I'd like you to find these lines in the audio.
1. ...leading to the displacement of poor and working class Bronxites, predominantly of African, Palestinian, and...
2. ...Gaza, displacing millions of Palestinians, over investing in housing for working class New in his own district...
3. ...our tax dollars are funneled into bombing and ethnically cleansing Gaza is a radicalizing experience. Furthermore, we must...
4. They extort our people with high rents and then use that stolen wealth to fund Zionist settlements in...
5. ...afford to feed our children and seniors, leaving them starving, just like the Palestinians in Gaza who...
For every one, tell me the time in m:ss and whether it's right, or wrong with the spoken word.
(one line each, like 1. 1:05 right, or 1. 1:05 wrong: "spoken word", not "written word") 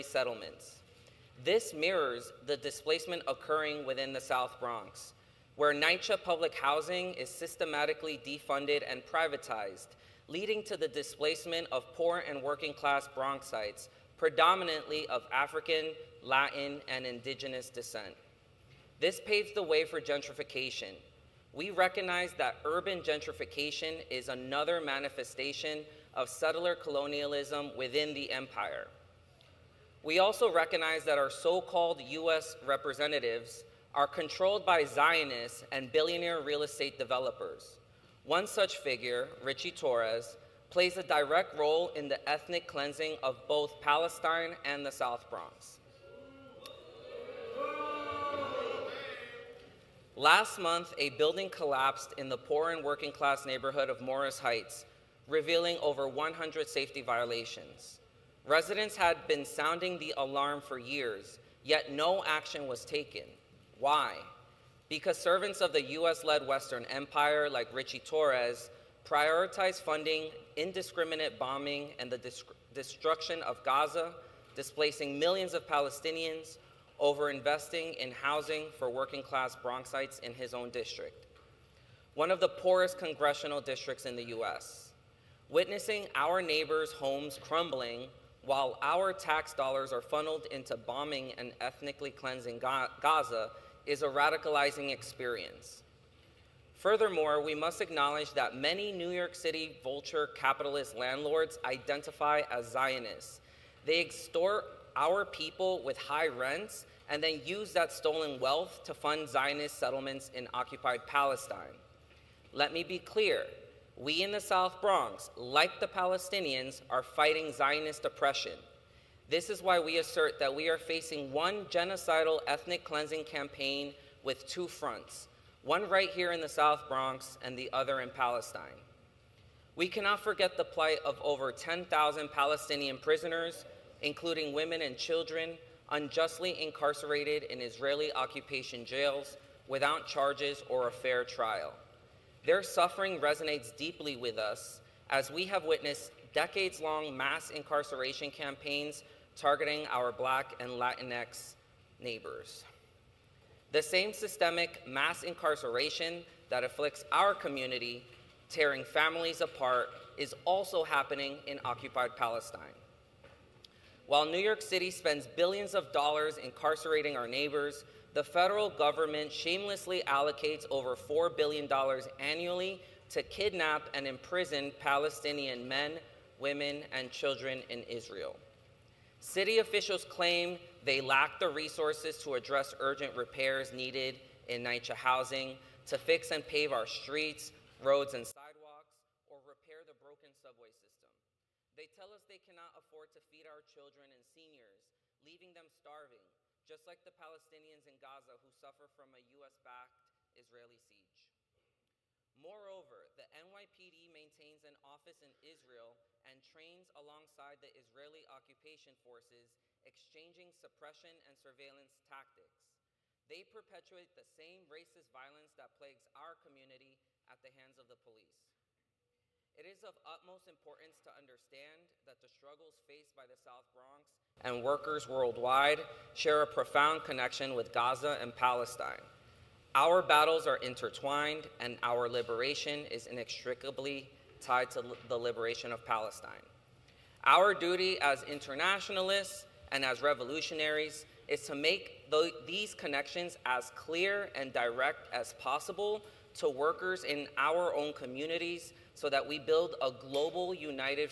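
1. 0:10 wrong: "Latin", not "Palestinian"
2. 1:13 wrong: "Bronxites", not "New"
3. 1:28 right
4. 1:43 right
5. 3:12 right.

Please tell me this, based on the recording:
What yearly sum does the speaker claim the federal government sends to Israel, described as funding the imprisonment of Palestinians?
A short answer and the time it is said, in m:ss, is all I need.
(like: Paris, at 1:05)
over $4 billion, at 2:50.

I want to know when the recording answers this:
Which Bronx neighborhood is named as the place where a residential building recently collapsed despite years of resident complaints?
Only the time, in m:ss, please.
0:54.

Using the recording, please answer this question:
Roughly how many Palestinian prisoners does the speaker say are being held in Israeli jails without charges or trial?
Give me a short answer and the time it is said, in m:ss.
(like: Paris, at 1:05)
over 10,000, at 2:11.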